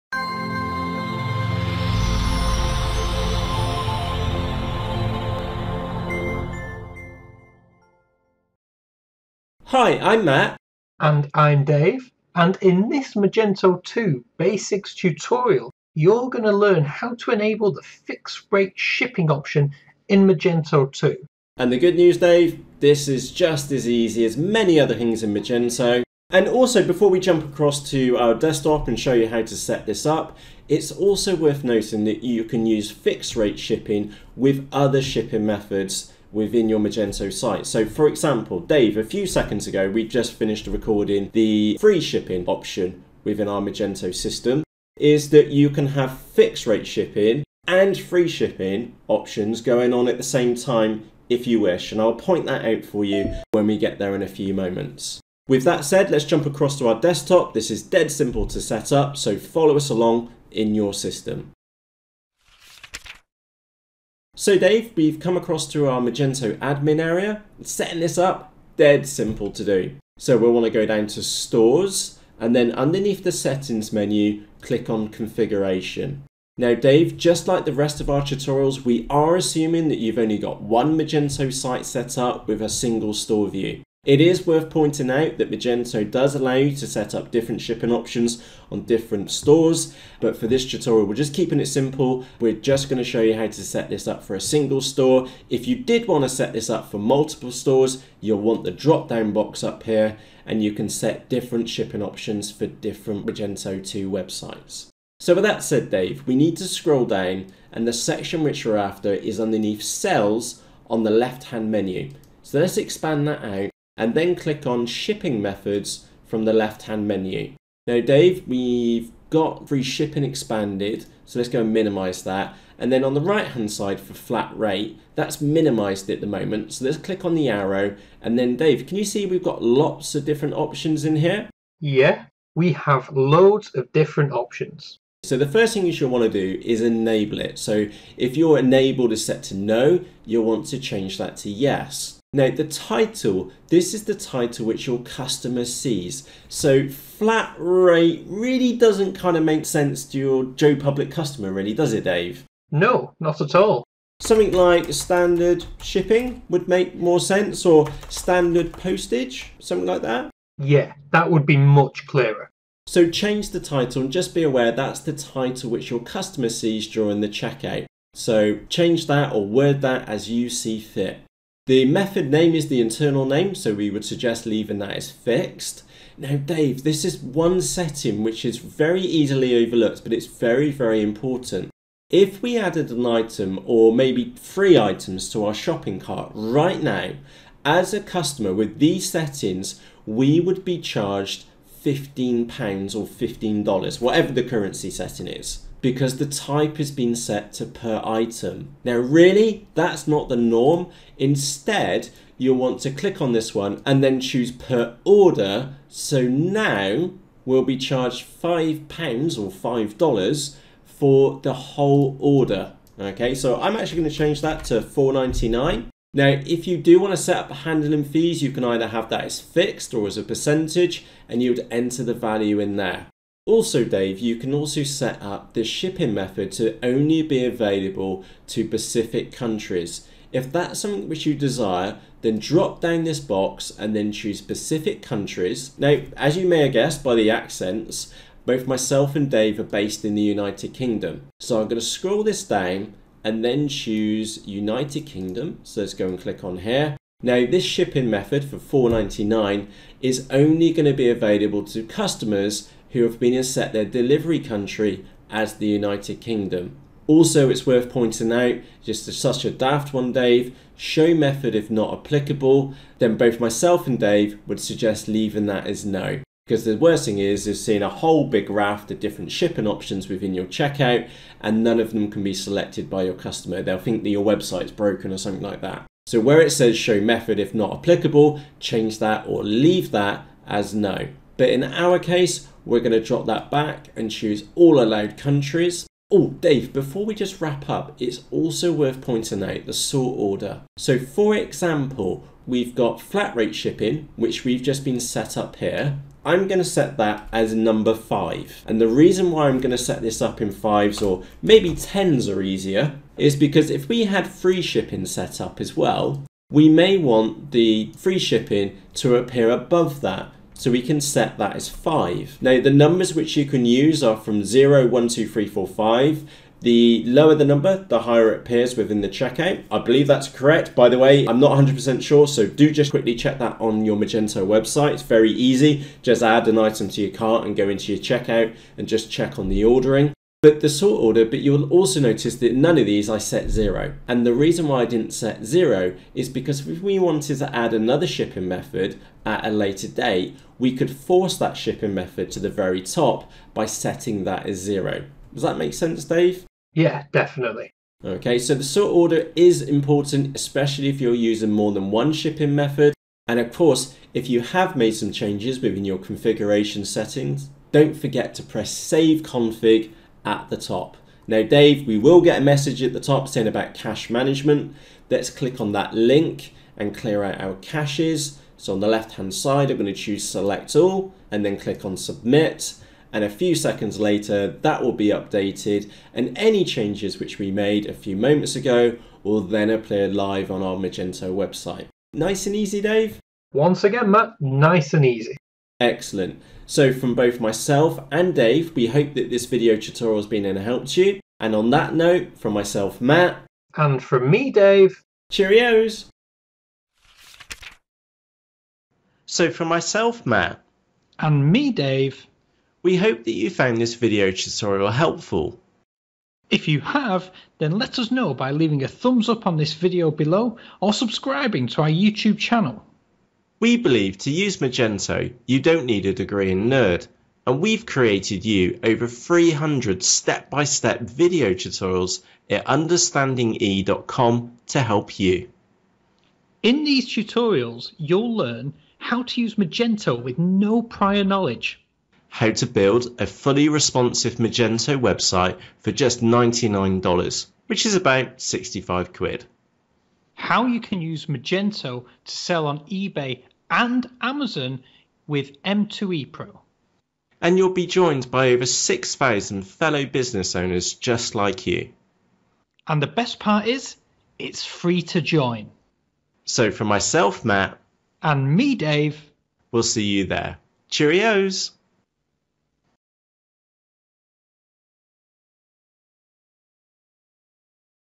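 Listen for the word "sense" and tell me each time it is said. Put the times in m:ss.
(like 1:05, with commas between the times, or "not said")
2:29, 2:37, 5:45.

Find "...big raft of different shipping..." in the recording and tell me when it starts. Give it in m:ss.
4:28.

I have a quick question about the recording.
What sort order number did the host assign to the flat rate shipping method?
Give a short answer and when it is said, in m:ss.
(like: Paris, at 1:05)
5, at 4:57.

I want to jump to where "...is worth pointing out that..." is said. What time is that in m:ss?
1:24.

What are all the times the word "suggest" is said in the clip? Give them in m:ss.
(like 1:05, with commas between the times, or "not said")
2:54, 4:24.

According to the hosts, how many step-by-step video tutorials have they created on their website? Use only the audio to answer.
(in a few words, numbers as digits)
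Over 300.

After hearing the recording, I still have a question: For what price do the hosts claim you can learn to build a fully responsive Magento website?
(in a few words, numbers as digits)
$99.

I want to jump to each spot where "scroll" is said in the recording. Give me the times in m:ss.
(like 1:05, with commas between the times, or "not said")
1:46, 4:01.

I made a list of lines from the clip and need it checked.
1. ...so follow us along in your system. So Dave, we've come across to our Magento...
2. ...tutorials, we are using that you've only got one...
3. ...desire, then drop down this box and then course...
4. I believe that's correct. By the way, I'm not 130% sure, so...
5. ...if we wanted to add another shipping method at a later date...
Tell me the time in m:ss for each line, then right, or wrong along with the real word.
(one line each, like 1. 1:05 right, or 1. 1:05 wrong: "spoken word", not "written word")
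1. 0:59 right
2. 1:18 wrong: "assuming", not "using"
3. 3:51 wrong: "choose", not "course"
4. 5:19 wrong: "100", not "130"
5. 5:36 right.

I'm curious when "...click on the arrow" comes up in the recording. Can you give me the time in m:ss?
2:06.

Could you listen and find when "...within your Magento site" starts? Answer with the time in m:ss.
0:36.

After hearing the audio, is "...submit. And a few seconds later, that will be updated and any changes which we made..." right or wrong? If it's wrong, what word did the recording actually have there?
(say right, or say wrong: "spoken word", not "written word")
right.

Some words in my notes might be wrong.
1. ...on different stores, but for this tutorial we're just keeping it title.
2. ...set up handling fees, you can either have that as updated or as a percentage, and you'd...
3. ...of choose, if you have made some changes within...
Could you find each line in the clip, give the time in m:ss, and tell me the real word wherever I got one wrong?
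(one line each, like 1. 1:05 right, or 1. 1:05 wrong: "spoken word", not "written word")
1. 1:28 wrong: "simple", not "title"
2. 3:37 wrong: "fixed", not "updated"
3. 5:53 wrong: "course", not "choose".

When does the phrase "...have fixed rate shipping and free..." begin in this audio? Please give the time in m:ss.
0:45.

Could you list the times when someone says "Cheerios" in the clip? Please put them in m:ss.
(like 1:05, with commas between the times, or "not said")
6:35, 7:40.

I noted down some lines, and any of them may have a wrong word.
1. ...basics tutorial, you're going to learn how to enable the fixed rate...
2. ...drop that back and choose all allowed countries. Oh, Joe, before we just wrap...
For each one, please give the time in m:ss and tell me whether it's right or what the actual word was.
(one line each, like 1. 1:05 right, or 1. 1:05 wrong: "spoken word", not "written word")
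1. 0:14 right
2. 4:43 wrong: "Dave", not "Joe".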